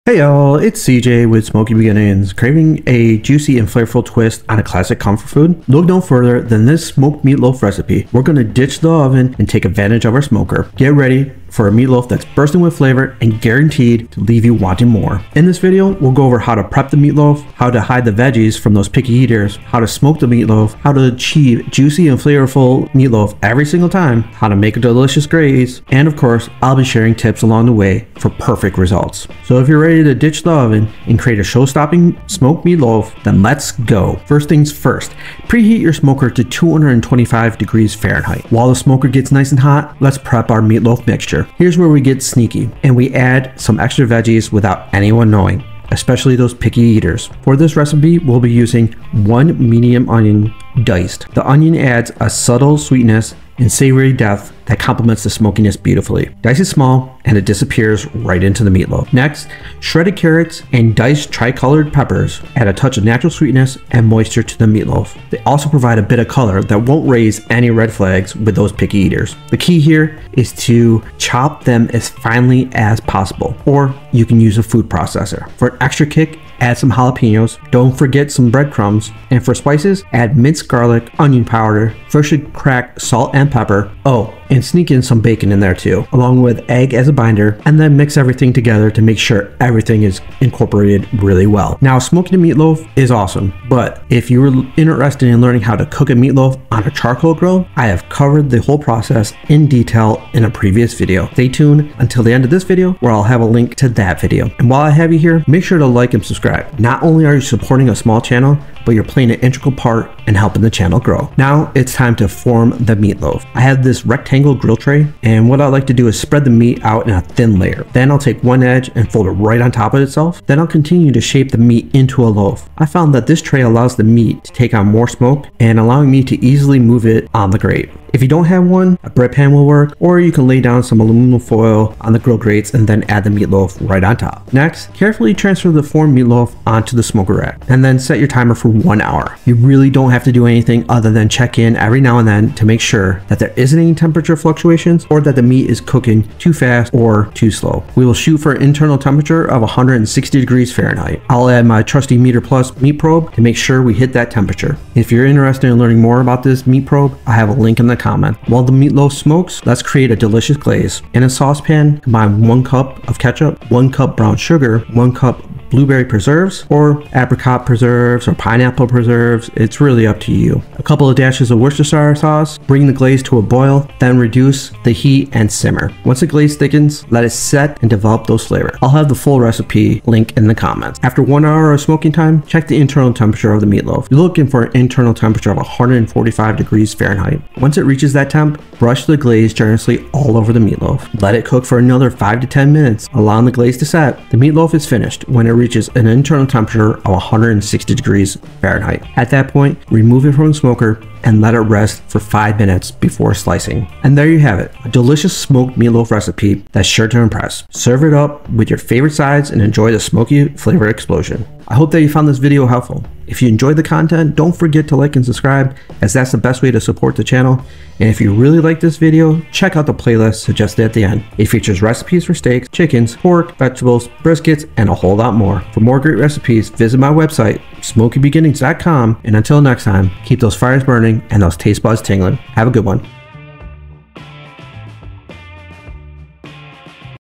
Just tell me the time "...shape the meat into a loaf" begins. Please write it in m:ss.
2:01.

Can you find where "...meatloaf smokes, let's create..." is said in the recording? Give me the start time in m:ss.
2:38.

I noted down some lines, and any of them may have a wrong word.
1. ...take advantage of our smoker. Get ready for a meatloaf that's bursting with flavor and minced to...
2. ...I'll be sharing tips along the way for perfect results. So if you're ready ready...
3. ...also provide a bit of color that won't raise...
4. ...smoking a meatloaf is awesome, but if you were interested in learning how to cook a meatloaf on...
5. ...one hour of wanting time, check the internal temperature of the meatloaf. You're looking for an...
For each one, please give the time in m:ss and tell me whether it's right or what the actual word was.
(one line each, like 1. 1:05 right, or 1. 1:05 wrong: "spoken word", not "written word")
1. 0:09 wrong: "guaranteed", not "minced"
2. 0:26 right
3. 1:05 right
4. 1:31 right
5. 3:01 wrong: "smoking", not "wanting".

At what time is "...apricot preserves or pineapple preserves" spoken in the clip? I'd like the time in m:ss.
2:47.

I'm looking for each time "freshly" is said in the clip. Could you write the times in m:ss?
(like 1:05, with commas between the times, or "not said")
1:22.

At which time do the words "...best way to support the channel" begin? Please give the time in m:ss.
3:36.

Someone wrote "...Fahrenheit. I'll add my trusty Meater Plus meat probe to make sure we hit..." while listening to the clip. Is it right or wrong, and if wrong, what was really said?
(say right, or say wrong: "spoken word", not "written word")
right.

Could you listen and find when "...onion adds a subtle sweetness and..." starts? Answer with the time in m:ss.
0:51.